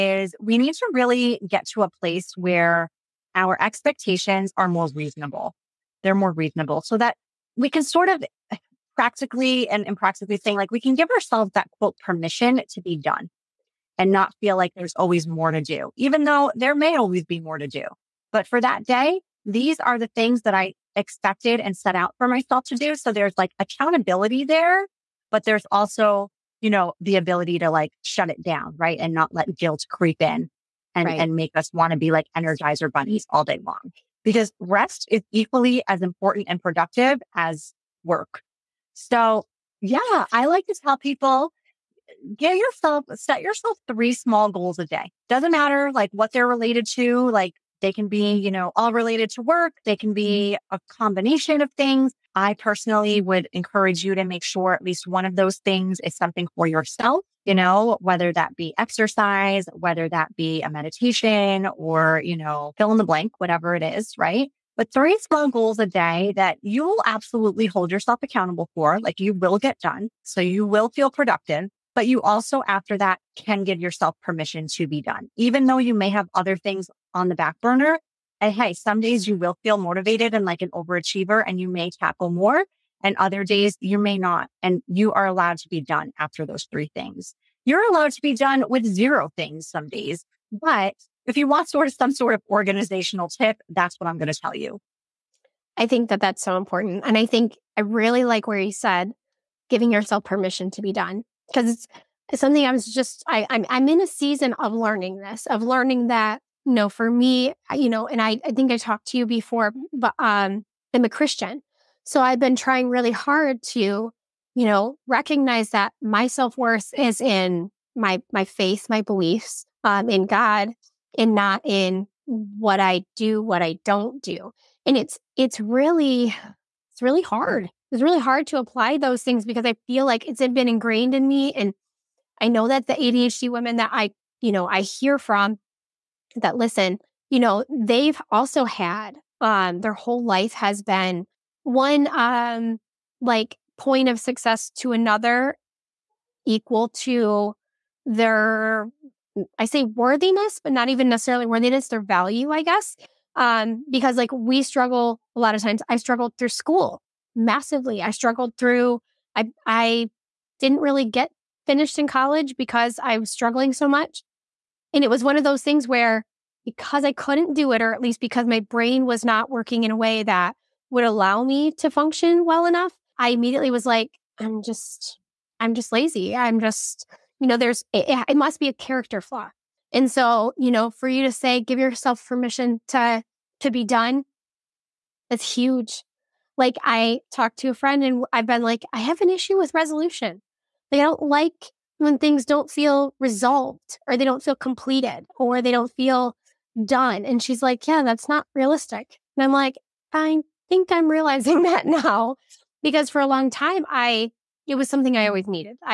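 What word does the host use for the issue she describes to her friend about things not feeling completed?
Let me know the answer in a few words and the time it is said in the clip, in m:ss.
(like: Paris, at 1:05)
resolution, at 3:09.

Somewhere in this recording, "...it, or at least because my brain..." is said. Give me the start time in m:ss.
2:47.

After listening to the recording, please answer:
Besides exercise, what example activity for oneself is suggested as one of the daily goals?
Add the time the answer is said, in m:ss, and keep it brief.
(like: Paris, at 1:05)
meditation, at 1:00.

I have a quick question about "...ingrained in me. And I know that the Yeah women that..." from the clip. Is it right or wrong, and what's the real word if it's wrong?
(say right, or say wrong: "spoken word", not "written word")
wrong: "ADHD", not "Yeah".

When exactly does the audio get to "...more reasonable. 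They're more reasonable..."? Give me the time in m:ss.
0:04.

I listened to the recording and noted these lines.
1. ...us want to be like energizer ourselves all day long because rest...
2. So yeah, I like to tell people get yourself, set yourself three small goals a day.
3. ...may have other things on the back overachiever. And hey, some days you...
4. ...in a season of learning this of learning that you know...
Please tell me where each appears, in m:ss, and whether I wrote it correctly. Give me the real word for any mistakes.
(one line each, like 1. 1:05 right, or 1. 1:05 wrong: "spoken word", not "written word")
1. 0:31 wrong: "bunnies", not "ourselves"
2. 0:38 right
3. 1:15 wrong: "burner", not "overachiever"
4. 1:43 right.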